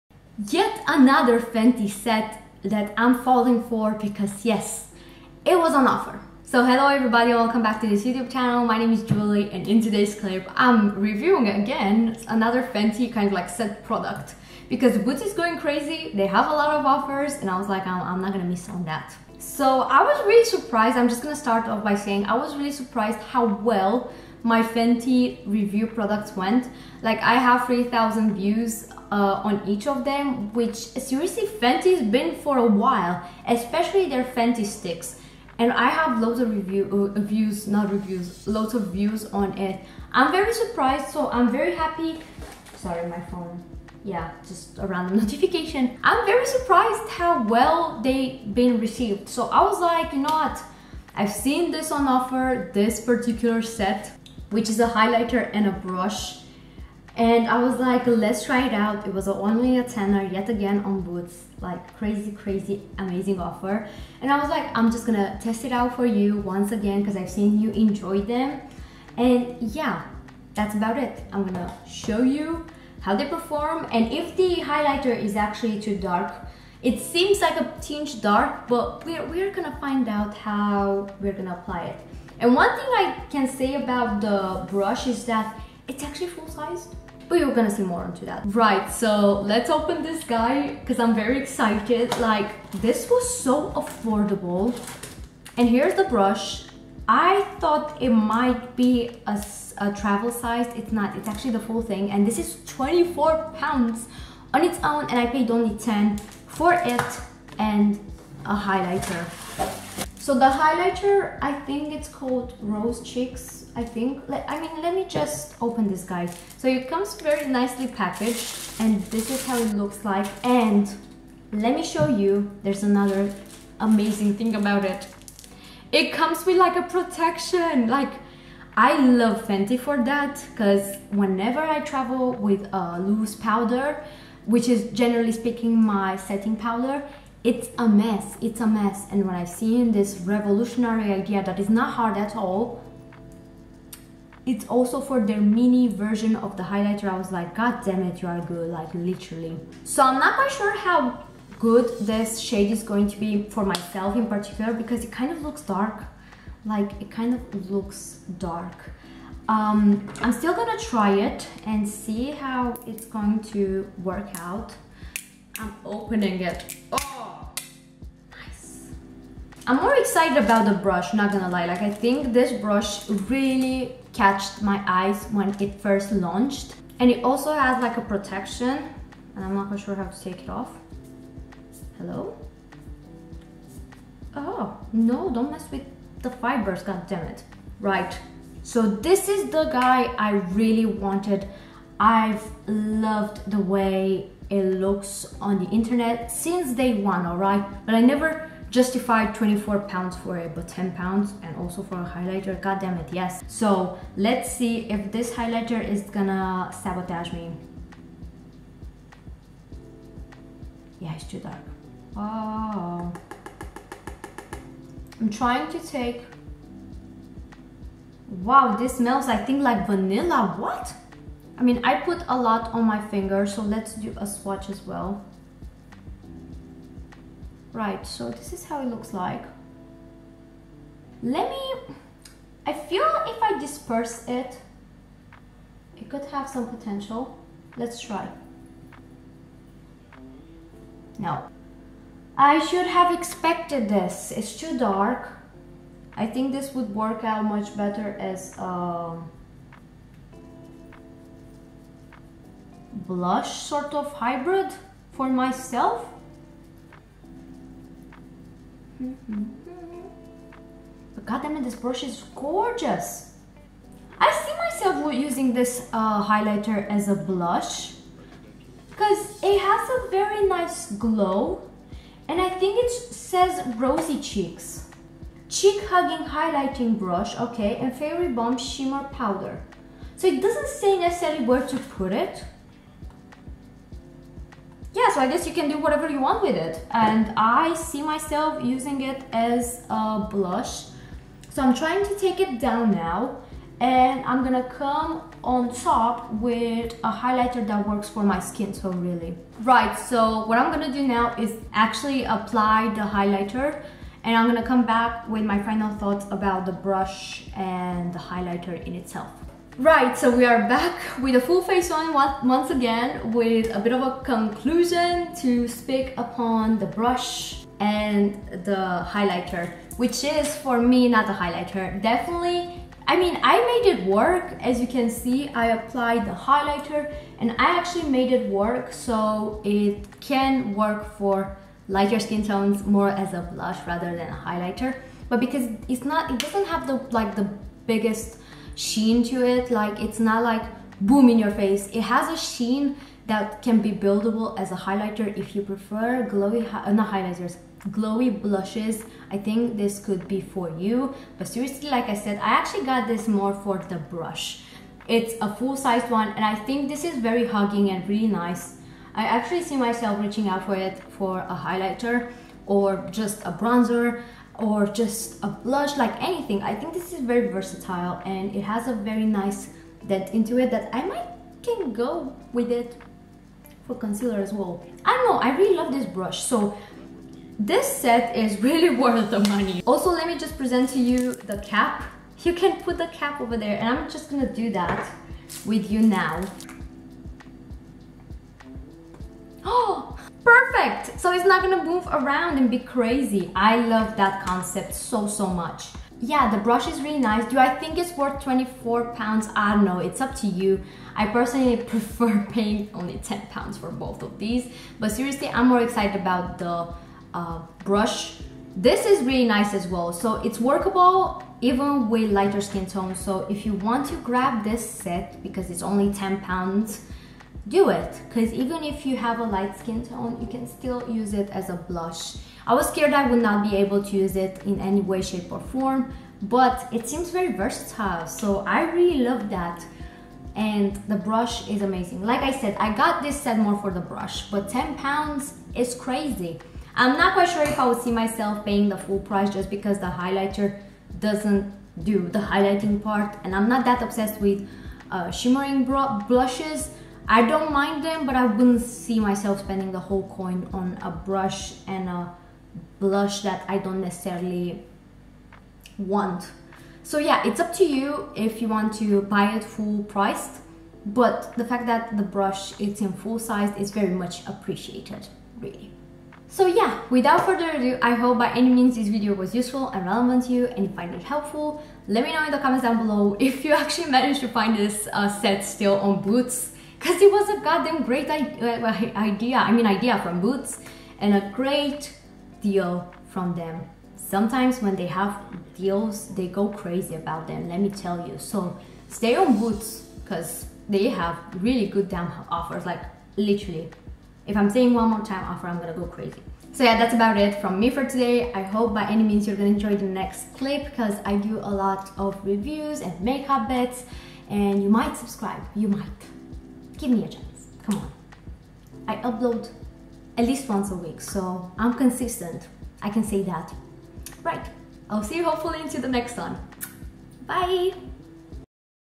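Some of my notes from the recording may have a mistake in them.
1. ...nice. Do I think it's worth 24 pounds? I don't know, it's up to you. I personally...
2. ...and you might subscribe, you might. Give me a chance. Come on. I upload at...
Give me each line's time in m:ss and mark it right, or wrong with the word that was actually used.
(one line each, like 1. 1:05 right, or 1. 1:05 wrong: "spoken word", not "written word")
1. 6:37 right
2. 8:24 right.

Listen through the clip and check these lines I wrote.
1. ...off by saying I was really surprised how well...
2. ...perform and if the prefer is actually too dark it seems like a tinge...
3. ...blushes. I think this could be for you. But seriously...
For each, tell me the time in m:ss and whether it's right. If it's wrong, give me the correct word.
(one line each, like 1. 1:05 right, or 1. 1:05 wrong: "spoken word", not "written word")
1. 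0:21 right
2. 1:13 wrong: "highlighter", not "prefer"
3. 5:48 right.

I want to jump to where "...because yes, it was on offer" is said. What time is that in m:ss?
0:03.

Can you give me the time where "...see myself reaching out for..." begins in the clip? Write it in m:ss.
5:59.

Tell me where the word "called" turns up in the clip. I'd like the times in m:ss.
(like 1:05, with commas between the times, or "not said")
1:52.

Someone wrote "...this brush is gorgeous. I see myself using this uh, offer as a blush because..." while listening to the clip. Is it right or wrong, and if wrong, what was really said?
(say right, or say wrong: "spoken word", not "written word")
wrong: "highlighter", not "offer".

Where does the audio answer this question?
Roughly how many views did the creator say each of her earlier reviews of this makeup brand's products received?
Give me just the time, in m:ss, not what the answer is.
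0:27.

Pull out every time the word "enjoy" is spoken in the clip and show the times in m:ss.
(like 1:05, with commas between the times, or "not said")
1:07, 8:19.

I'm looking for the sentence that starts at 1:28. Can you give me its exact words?
Right, so let's open this guy because I'm very excited.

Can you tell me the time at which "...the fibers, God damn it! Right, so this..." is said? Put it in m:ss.
3:06.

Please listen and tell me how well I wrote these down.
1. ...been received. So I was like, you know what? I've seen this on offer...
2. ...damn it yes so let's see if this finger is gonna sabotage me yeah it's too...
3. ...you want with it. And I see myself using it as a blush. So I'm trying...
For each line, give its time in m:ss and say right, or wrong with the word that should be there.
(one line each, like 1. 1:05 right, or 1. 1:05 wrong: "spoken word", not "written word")
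1. 0:48 right
2. 3:22 wrong: "highlighter", not "finger"
3. 4:46 right.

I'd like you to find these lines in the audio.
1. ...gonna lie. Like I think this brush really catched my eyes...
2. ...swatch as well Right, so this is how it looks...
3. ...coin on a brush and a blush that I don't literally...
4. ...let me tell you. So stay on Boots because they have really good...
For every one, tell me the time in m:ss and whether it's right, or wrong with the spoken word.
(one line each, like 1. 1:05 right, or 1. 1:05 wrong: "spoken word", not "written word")
1. 2:51 right
2. 3:44 right
3. 7:30 wrong: "necessarily", not "literally"
4. 8:07 right.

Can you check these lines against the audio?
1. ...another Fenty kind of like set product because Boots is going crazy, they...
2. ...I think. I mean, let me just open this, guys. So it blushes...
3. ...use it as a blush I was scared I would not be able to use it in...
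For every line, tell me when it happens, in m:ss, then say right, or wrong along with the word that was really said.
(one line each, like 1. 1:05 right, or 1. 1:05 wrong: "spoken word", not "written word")
1. 0:12 right
2. 1:53 wrong: "comes", not "blushes"
3. 7:01 right.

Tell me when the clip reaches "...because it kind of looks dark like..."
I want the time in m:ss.
2:34.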